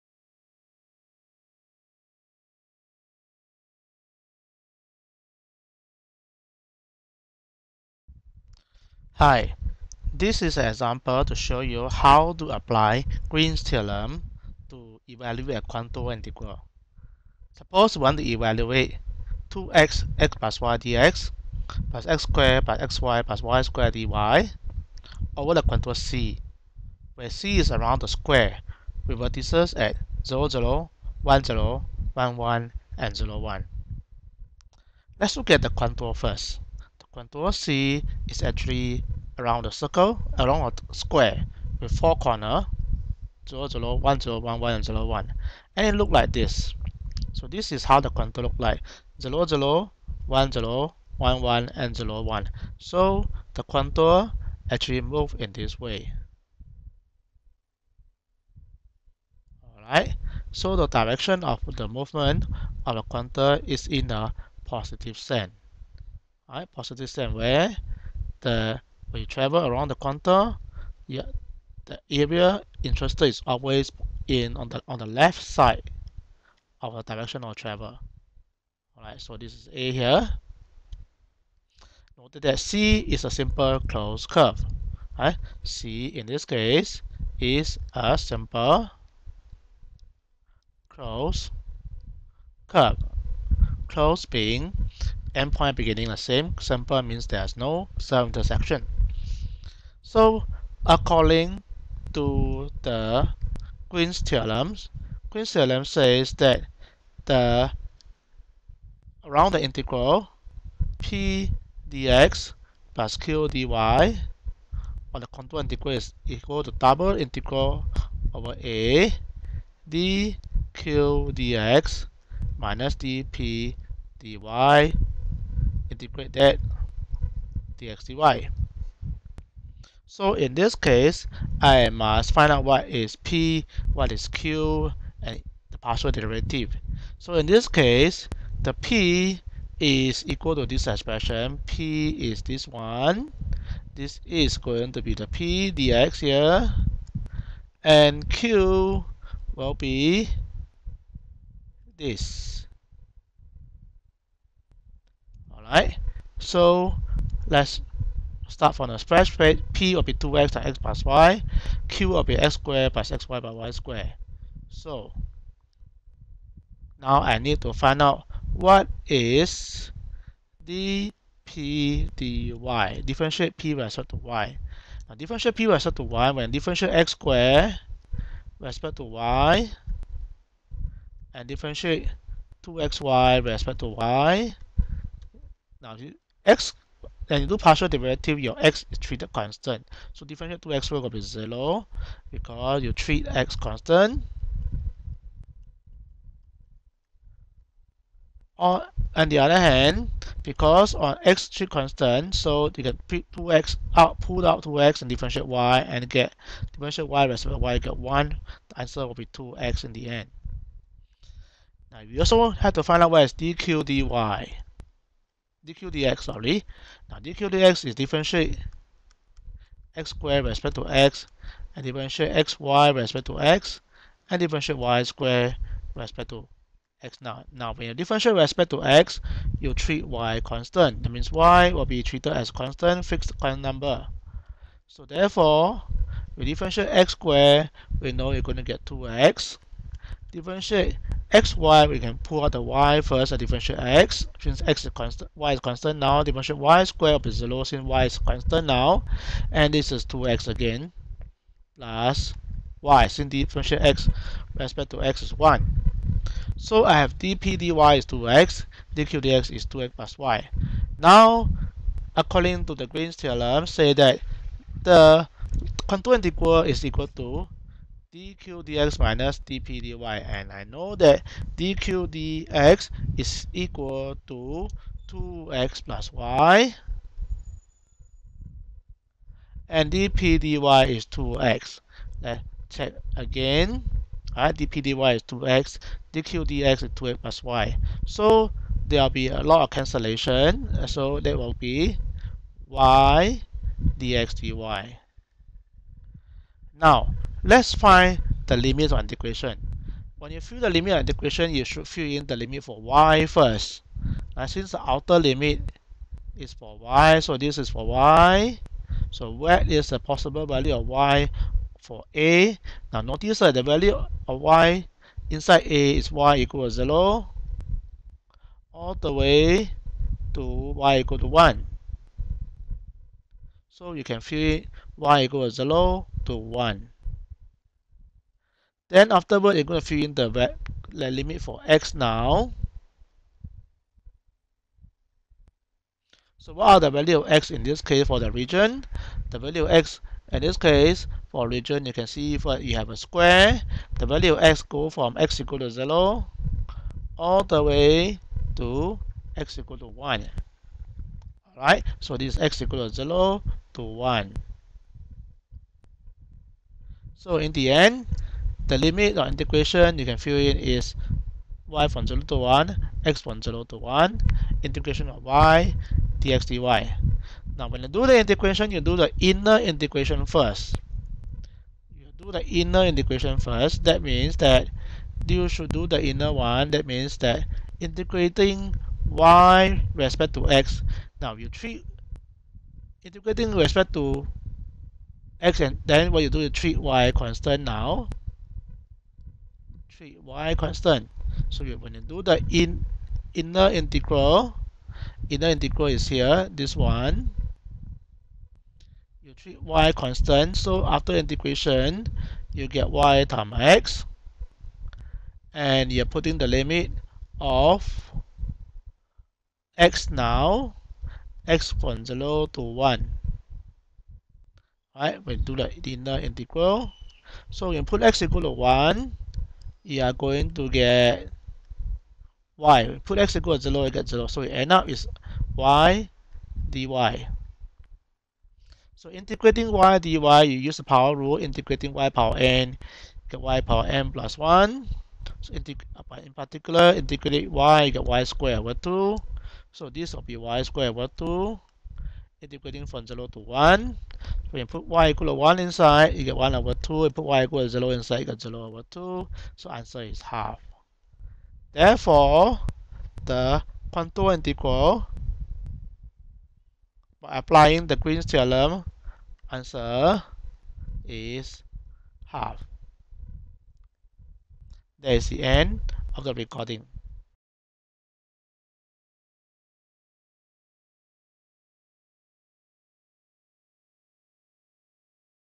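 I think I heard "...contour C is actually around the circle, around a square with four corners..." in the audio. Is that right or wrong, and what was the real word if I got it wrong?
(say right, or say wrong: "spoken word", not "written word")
right.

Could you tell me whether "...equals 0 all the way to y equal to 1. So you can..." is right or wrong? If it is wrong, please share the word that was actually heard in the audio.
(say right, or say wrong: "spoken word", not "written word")
right.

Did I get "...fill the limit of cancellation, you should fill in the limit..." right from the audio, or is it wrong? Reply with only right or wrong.
wrong.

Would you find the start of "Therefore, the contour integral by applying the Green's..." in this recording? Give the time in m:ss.
7:31.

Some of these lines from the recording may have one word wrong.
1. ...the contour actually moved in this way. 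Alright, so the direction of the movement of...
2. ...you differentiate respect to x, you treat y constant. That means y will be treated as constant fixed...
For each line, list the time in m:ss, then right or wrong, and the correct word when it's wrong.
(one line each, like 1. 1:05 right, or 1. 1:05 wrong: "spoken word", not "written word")
1. 0:53 right
2. 3:47 right.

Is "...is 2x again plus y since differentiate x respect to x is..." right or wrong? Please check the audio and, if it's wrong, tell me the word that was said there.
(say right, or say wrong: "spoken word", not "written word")
right.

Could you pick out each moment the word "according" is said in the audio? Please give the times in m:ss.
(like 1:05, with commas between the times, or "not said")
1:40, 4:22.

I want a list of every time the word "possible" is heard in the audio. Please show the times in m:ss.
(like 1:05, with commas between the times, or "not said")
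5:09.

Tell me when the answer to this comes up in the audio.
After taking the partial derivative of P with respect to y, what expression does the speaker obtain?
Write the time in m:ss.
3:28.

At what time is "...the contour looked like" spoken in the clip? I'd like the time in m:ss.
0:47.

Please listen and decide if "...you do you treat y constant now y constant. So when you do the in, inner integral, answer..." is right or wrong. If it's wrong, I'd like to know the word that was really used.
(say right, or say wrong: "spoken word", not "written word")
wrong: "inner", not "answer".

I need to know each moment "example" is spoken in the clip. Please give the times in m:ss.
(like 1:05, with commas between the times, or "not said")
0:10.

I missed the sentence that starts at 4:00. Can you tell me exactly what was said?
Differentiate x, y, we can pull out the y first and differentiate x.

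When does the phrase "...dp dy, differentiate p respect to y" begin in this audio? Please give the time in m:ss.
2:50.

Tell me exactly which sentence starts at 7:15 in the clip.
So uh, in particular, integrate y, get y squared over 2.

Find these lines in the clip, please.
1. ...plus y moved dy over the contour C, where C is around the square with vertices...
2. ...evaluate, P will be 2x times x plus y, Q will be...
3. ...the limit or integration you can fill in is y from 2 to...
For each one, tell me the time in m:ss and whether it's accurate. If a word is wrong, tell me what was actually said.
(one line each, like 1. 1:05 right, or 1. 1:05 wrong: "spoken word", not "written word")
1. 0:23 wrong: "squared", not "moved"
2. 2:39 wrong: "plate", not "evaluate"
3. 5:58 wrong: "0", not "2".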